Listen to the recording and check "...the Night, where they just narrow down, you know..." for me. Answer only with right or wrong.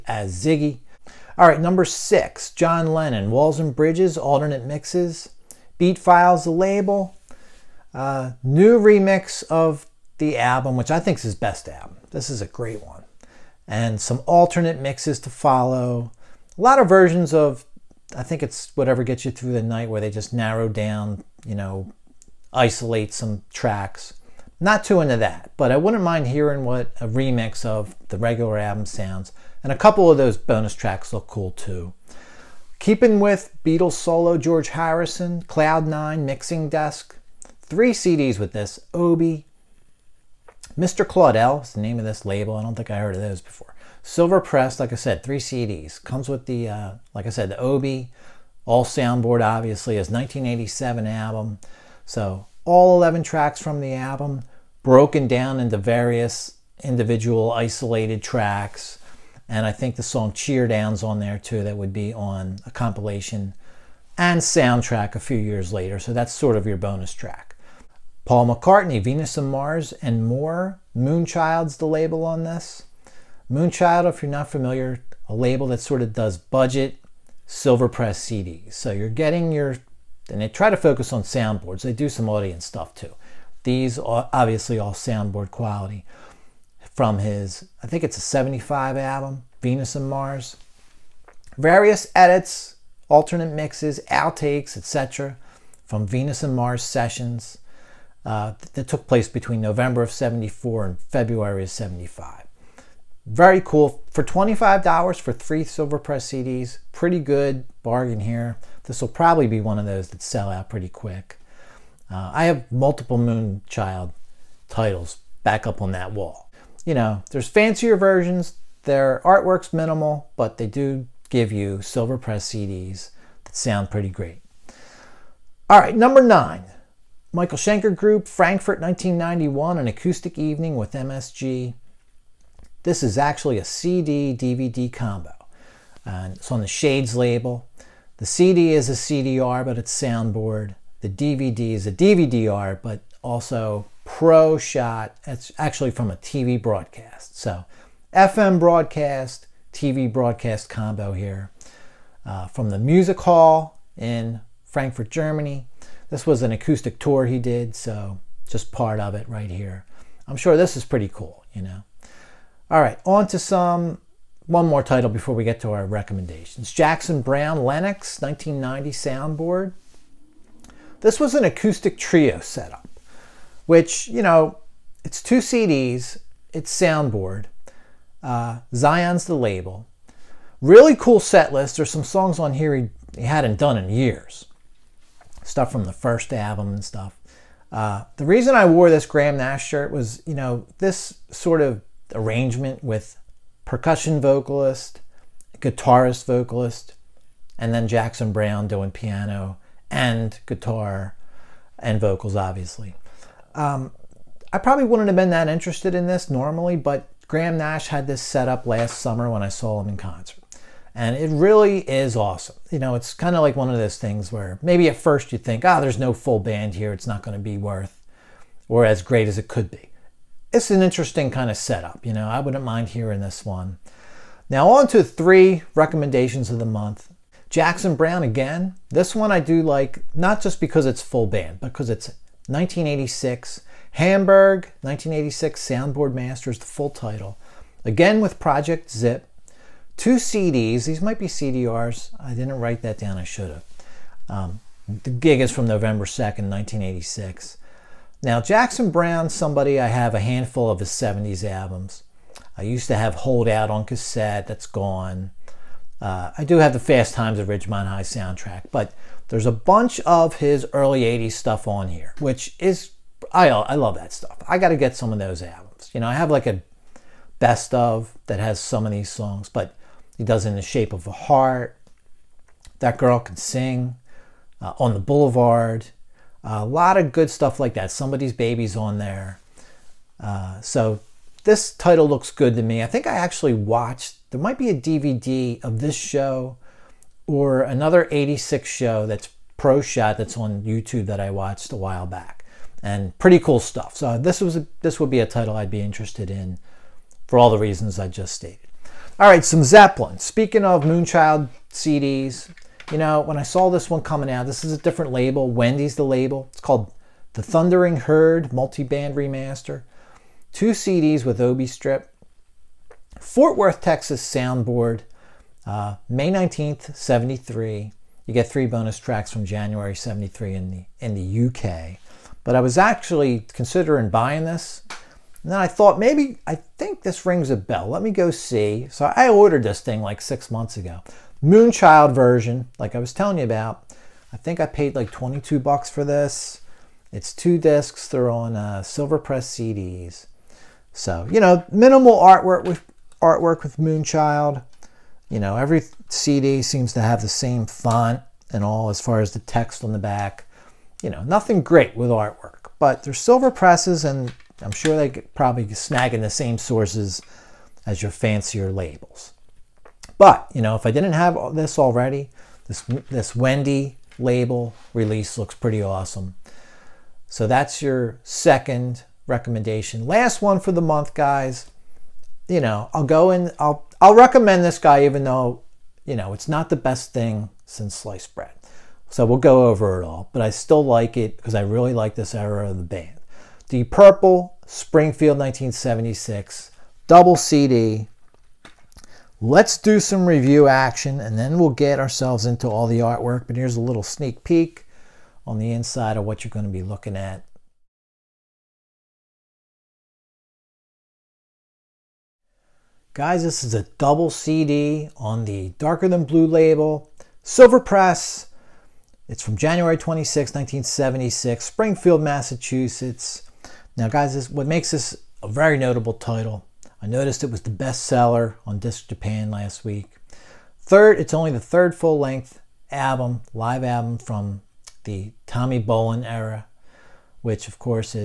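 right.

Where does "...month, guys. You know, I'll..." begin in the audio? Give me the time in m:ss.
6:10.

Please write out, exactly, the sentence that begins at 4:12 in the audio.
I used to have Hold Out on cassette, that's gone.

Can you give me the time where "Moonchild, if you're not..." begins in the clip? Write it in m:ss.
1:13.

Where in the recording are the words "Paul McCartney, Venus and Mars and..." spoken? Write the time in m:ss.
1:08.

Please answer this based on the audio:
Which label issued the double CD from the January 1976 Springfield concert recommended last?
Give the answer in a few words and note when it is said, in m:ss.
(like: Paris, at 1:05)
Darker Than Blue, at 6:45.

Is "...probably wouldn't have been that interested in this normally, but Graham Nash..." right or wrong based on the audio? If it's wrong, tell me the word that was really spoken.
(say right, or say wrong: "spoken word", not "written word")
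right.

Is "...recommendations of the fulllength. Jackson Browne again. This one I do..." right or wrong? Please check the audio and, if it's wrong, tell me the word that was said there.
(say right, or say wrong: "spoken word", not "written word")
wrong: "month", not "fulllength".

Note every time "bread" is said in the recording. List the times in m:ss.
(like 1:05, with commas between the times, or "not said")
6:18.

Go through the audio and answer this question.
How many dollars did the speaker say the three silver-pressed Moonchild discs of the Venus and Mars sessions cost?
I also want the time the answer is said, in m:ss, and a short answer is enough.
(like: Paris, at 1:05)
$25, at 1:44.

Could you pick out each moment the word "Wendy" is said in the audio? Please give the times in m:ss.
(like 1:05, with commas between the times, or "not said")
5:05, 6:03.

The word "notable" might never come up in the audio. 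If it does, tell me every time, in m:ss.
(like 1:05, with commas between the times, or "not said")
6:55.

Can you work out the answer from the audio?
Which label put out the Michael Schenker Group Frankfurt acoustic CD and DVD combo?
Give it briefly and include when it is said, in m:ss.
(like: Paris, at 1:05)
Shades, at 2:16.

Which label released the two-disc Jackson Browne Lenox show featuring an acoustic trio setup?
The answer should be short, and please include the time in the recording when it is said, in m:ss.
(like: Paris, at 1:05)
Zion, at 2:58.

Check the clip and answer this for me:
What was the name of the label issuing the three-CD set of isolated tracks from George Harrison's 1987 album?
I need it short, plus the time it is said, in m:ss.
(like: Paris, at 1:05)
Mr. Claudel, at 0:40.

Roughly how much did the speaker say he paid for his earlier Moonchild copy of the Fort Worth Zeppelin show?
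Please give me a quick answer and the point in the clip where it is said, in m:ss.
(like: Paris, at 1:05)
$22, at 5:35.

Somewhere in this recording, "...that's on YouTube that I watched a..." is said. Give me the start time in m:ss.
4:50.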